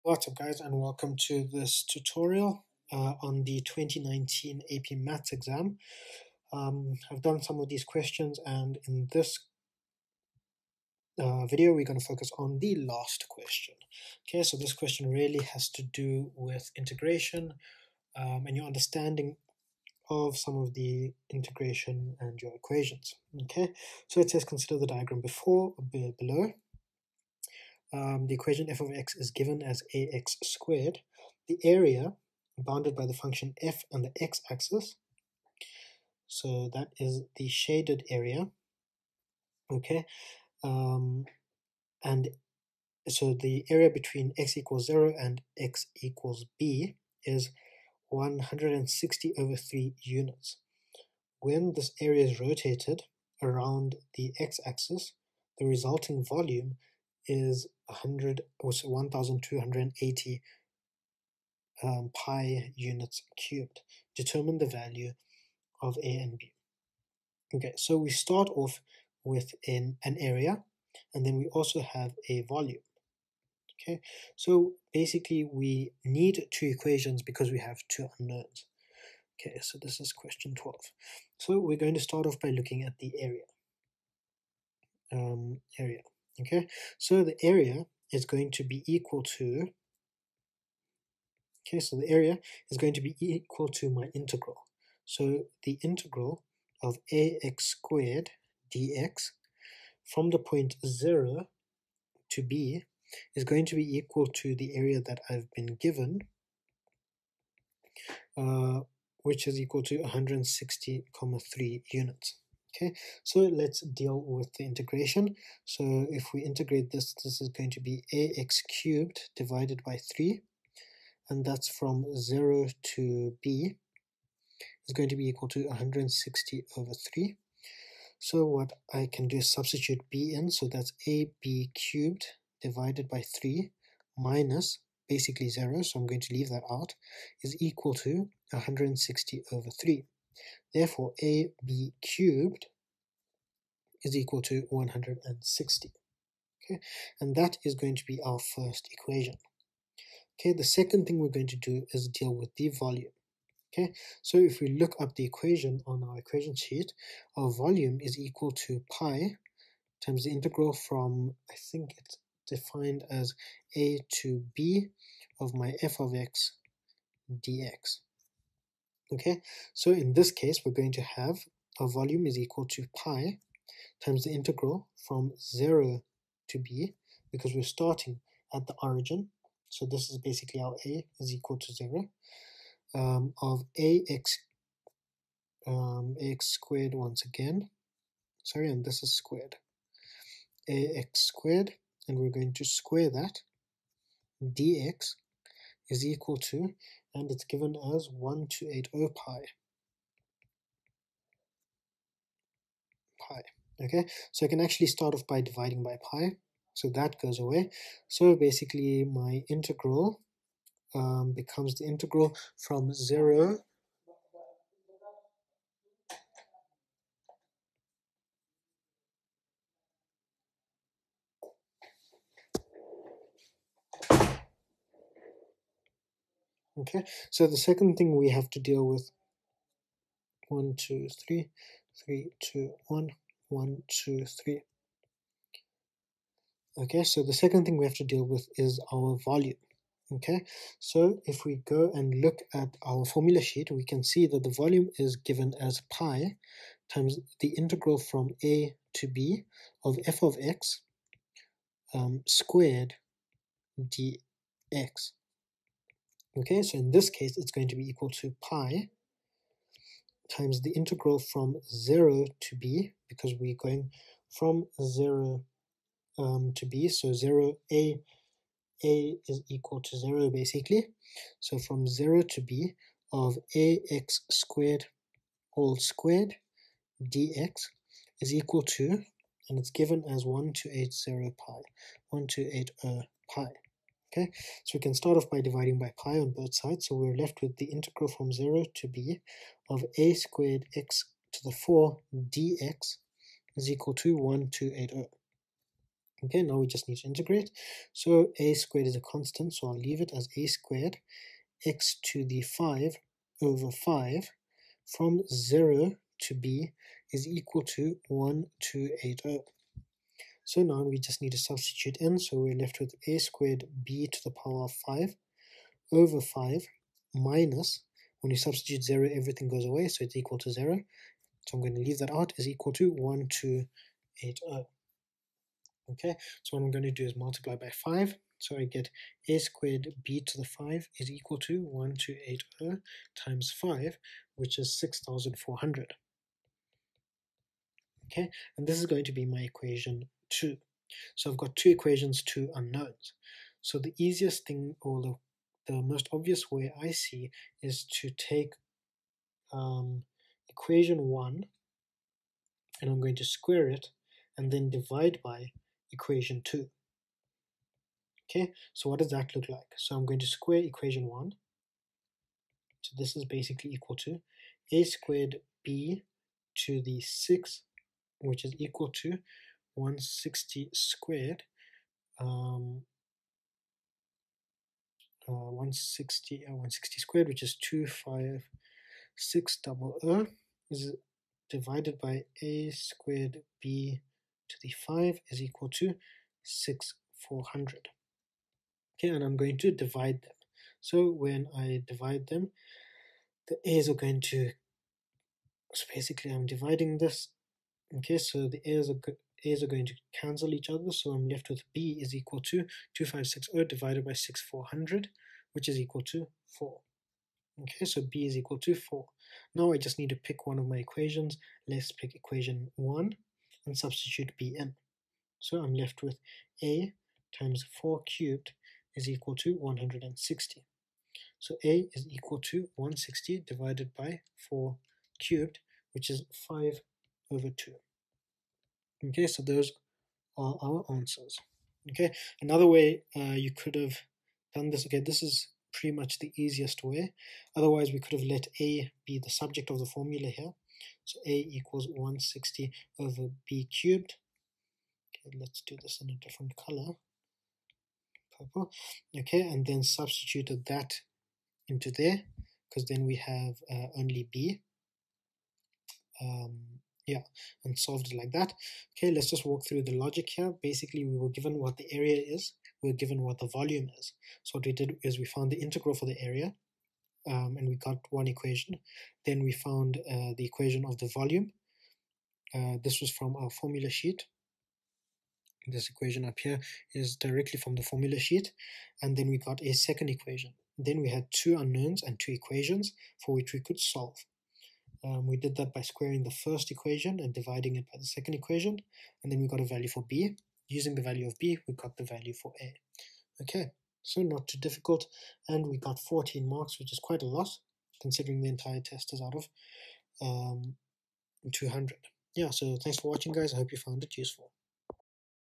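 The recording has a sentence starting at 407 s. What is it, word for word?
Okay, so B is equal to 4.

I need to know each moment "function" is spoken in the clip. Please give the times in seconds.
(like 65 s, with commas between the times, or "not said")
33 s.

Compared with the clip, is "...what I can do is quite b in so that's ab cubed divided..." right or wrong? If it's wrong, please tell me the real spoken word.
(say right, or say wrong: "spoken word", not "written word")
wrong: "substitute", not "quite".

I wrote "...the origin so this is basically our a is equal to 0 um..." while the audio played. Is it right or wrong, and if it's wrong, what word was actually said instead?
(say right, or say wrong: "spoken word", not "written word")
right.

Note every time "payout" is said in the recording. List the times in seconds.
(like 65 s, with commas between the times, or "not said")
not said.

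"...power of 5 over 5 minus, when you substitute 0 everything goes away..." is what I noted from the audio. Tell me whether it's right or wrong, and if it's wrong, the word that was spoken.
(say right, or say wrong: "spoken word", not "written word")
right.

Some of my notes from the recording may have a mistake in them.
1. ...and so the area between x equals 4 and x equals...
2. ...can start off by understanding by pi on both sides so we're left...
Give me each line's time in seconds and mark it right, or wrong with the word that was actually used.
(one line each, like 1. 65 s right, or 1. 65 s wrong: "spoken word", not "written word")
1. 42 s wrong: "0", not "4"
2. 284 s wrong: "dividing", not "understanding".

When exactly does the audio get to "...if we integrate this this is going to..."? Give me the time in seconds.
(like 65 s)
116 s.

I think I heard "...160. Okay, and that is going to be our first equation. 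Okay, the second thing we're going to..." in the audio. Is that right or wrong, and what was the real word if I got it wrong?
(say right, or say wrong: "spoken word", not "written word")
right.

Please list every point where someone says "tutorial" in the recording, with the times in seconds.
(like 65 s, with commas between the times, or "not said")
1 s.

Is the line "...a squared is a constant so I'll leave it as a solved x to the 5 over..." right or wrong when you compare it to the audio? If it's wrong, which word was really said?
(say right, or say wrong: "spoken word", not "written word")
wrong: "squared", not "solved".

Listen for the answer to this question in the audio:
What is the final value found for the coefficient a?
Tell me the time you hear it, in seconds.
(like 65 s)
426 s.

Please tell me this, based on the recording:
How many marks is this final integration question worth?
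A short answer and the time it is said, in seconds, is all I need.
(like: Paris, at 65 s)
14, at 495 s.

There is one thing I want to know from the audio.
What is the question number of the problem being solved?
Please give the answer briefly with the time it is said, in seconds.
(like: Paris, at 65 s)
12, at 80 s.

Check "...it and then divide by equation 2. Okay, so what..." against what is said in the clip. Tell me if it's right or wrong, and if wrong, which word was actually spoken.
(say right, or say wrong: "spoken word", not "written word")
right.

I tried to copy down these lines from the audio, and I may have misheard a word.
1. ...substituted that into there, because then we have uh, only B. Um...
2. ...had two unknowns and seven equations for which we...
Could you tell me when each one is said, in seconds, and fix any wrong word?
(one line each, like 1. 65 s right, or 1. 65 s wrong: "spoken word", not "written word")
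1. 449 s right
2. 481 s wrong: "two", not "seven".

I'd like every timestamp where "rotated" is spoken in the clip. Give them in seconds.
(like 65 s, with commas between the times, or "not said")
52 s.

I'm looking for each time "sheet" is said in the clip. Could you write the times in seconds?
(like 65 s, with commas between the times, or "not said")
156 s, 243 s, 473 s, 478 s.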